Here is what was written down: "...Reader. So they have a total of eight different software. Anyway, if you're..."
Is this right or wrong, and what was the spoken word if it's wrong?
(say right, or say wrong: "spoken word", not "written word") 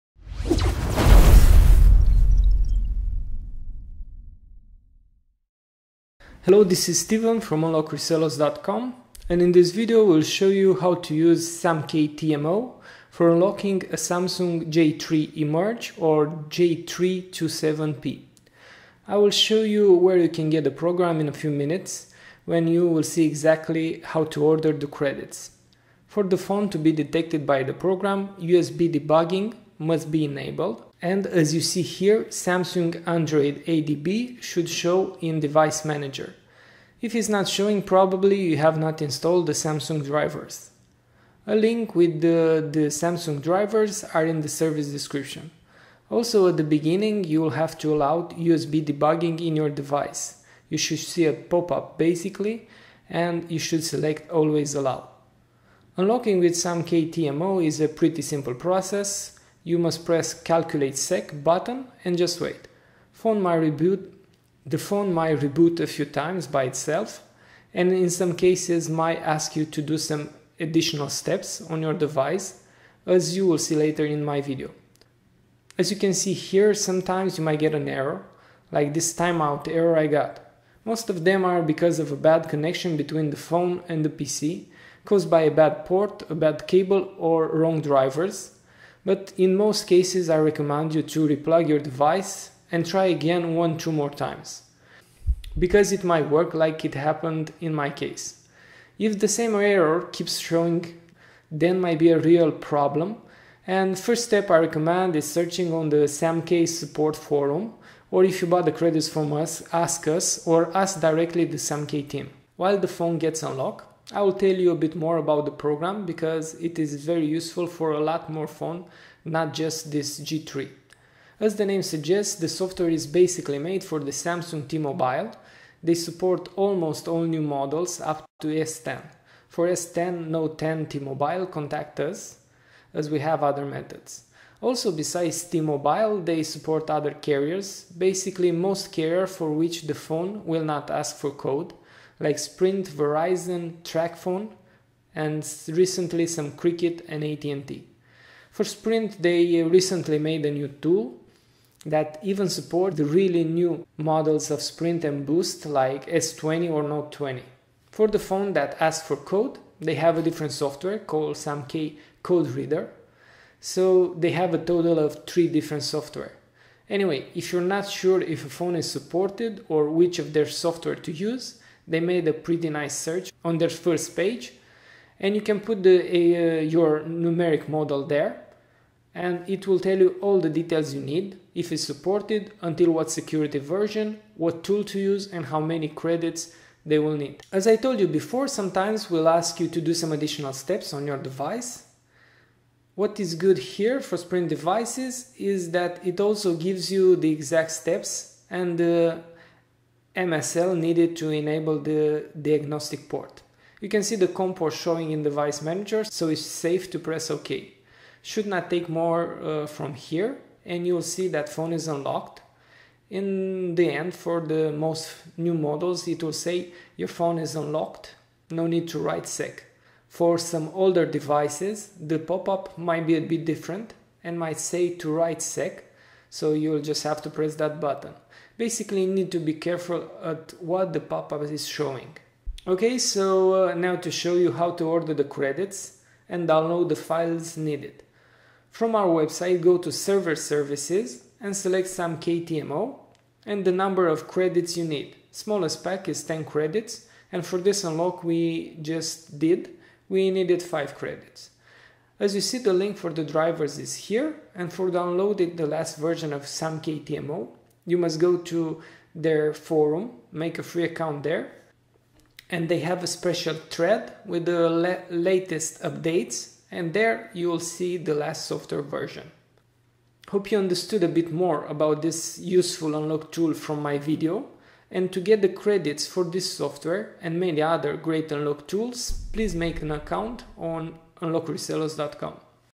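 wrong: "three", not "eight".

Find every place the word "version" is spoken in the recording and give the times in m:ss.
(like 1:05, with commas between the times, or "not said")
3:03, 4:15, 4:28.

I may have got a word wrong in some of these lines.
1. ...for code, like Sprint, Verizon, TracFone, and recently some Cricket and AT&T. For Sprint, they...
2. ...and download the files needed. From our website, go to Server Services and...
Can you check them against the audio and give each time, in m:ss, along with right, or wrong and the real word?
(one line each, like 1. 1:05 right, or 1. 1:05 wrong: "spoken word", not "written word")
1. 2:21 right
2. 3:56 right.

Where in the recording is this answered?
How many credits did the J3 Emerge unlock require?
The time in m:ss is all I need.
4:10.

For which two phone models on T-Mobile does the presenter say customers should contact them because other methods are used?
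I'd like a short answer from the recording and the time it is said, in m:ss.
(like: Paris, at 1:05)
S10, Note 10, at 2:09.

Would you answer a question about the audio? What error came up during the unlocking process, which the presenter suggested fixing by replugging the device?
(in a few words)
Timeout error.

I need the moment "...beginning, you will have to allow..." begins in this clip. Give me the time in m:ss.
0:46.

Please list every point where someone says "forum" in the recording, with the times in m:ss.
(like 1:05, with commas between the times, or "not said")
1:47, 4:19.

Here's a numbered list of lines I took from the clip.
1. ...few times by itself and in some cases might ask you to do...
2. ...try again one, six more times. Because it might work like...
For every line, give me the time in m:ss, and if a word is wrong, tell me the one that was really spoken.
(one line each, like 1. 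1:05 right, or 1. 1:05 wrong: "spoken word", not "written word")
1. 1:05 right
2. 1:32 wrong: "two", not "six".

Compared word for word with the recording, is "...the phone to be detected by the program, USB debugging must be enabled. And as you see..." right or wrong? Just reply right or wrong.
right.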